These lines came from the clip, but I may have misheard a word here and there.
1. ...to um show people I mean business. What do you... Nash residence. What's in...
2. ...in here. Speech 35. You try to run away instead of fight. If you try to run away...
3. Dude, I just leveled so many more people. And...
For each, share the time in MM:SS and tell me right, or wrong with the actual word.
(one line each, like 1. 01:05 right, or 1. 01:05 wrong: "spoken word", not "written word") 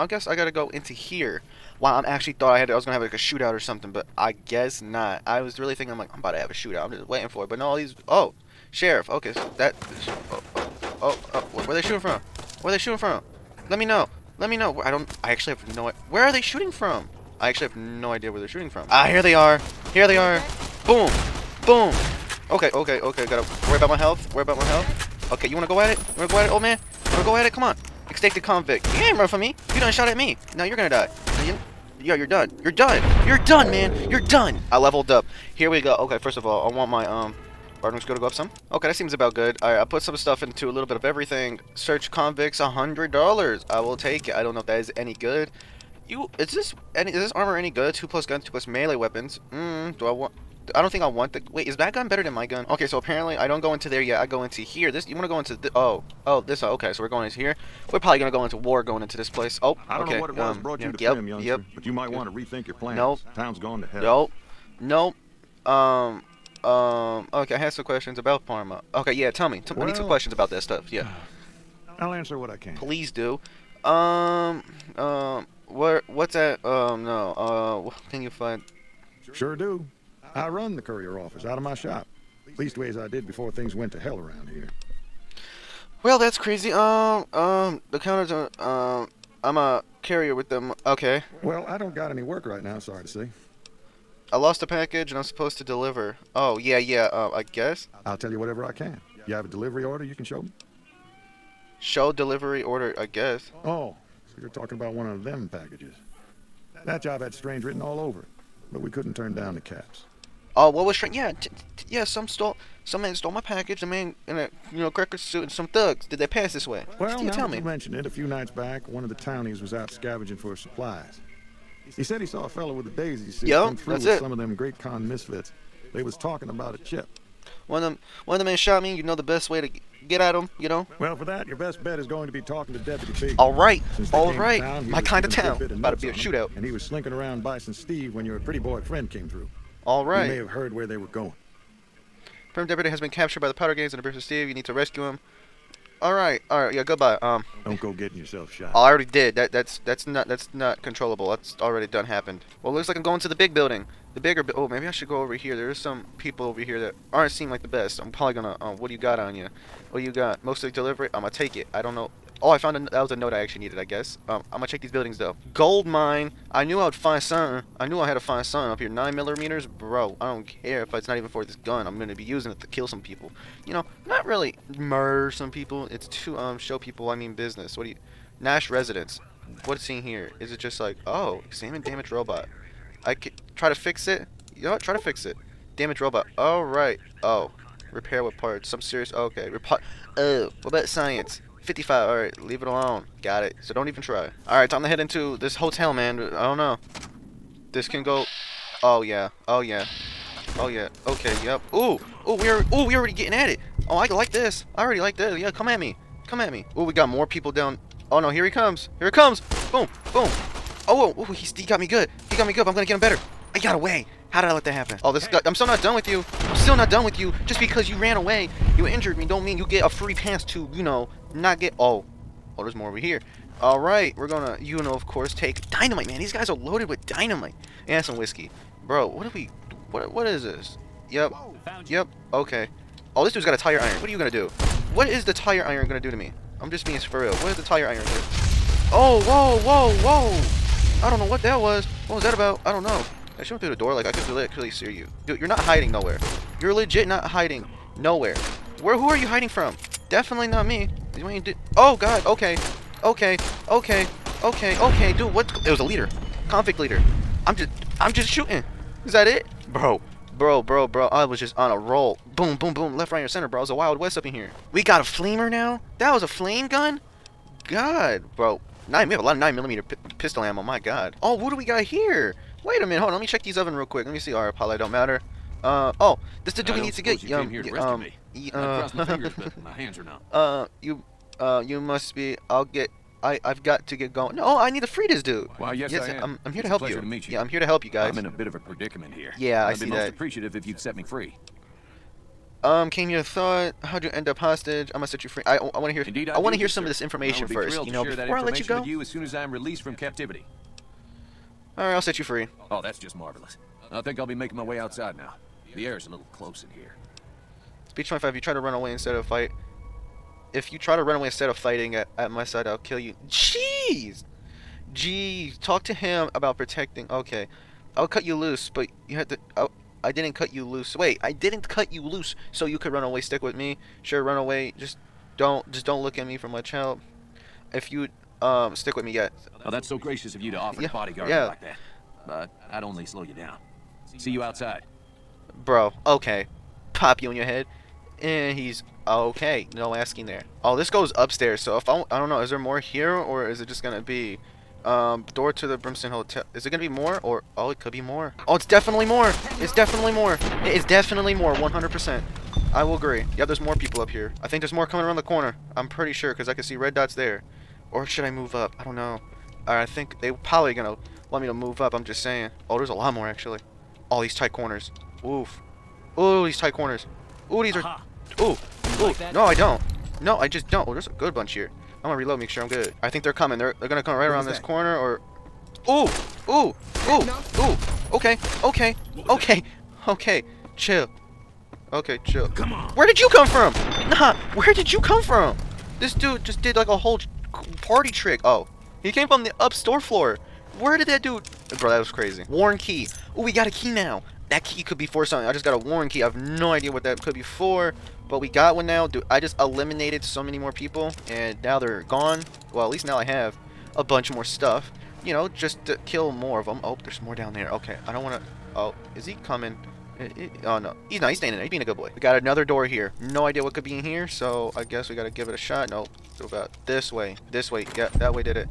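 1. 02:56 right
2. 05:06 wrong: "25", not "35"
3. 06:39 wrong: "eliminated", not "leveled".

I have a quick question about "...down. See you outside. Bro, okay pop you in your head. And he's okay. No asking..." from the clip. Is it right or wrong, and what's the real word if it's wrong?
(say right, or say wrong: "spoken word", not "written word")
right.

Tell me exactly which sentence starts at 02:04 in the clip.
some of them Great Khan misfits.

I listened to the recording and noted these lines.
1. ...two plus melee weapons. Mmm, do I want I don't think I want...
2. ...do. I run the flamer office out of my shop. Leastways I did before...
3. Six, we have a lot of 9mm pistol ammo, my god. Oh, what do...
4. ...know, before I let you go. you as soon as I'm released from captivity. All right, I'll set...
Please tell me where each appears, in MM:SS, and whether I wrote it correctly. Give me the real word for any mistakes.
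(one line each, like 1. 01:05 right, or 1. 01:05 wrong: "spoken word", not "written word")
1. 00:48 right
2. 01:19 wrong: "courier", not "flamer"
3. 04:28 wrong: "Nine", not "Six"
4. 04:57 right.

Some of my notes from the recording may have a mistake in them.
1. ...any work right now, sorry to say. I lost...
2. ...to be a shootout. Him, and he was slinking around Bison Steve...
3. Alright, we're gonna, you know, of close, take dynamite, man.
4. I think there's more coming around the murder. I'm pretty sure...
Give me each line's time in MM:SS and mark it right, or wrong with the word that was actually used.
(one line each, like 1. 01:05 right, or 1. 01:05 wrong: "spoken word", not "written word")
1. 01:32 right
2. 02:15 right
3. 03:43 wrong: "course", not "close"
4. 05:54 wrong: "corner", not "murder".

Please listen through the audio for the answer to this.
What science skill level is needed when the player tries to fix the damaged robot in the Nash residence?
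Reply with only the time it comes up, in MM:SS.
03:11.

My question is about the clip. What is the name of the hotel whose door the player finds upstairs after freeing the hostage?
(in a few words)
Brimston Hotel.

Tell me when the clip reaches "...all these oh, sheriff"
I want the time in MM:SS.
00:07.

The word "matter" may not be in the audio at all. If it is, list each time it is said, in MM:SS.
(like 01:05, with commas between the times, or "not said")
04:34.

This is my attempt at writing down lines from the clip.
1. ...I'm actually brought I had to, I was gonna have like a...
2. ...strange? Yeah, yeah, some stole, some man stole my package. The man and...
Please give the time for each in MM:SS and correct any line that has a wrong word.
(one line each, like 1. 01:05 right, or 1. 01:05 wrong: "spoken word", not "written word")
1. 00:01 wrong: "thought", not "brought"
2. 01:50 right.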